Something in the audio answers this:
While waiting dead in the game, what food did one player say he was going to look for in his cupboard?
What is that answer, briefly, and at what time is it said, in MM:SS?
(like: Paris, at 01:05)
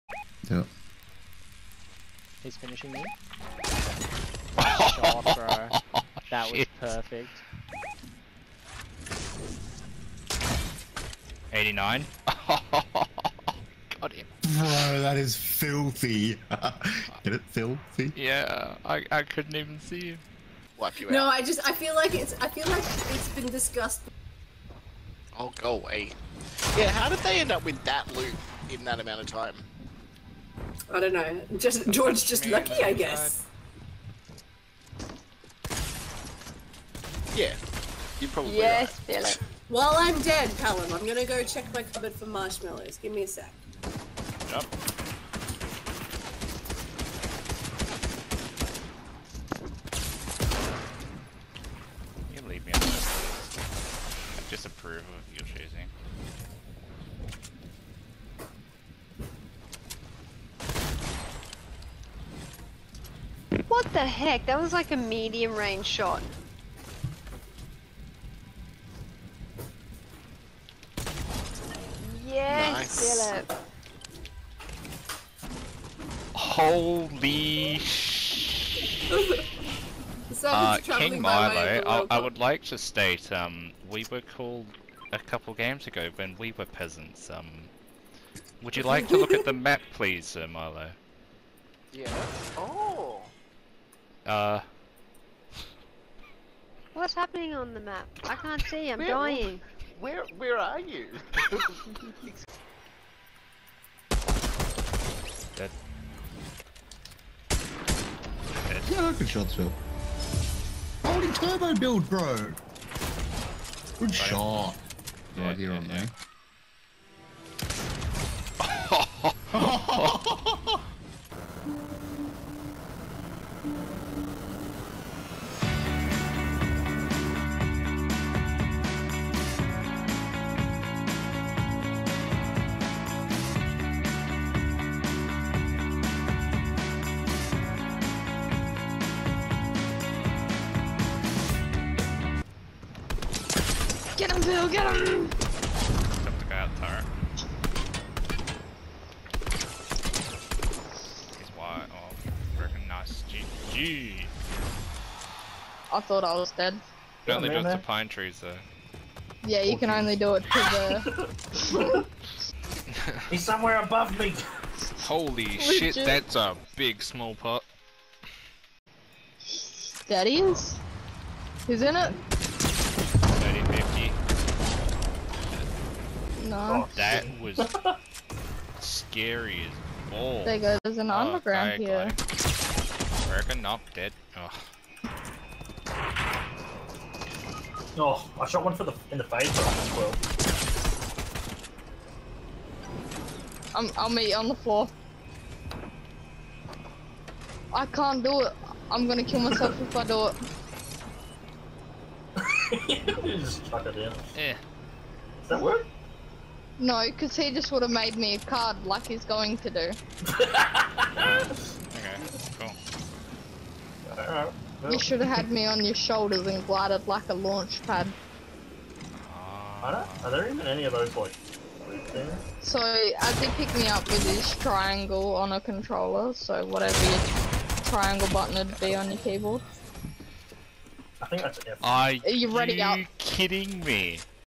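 marshmallows, at 00:42.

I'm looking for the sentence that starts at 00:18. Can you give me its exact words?
Yeah, I, I couldn't even see Wipe you no, out.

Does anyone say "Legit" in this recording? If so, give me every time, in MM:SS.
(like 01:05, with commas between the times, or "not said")
02:45.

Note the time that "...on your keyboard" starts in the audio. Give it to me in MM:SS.
03:48.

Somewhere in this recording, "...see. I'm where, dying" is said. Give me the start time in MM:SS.
01:38.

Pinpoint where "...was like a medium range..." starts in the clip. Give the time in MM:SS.
01:04.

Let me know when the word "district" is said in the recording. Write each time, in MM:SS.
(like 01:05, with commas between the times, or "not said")
not said.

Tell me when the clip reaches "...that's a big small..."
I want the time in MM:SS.
02:45.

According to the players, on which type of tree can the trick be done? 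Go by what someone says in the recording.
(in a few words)
pine trees.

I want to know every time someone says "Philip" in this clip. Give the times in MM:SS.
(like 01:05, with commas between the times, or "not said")
00:39, 01:13.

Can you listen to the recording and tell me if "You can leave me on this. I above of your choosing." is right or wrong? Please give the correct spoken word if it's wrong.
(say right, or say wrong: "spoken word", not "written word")
wrong: "disapprove", not "above".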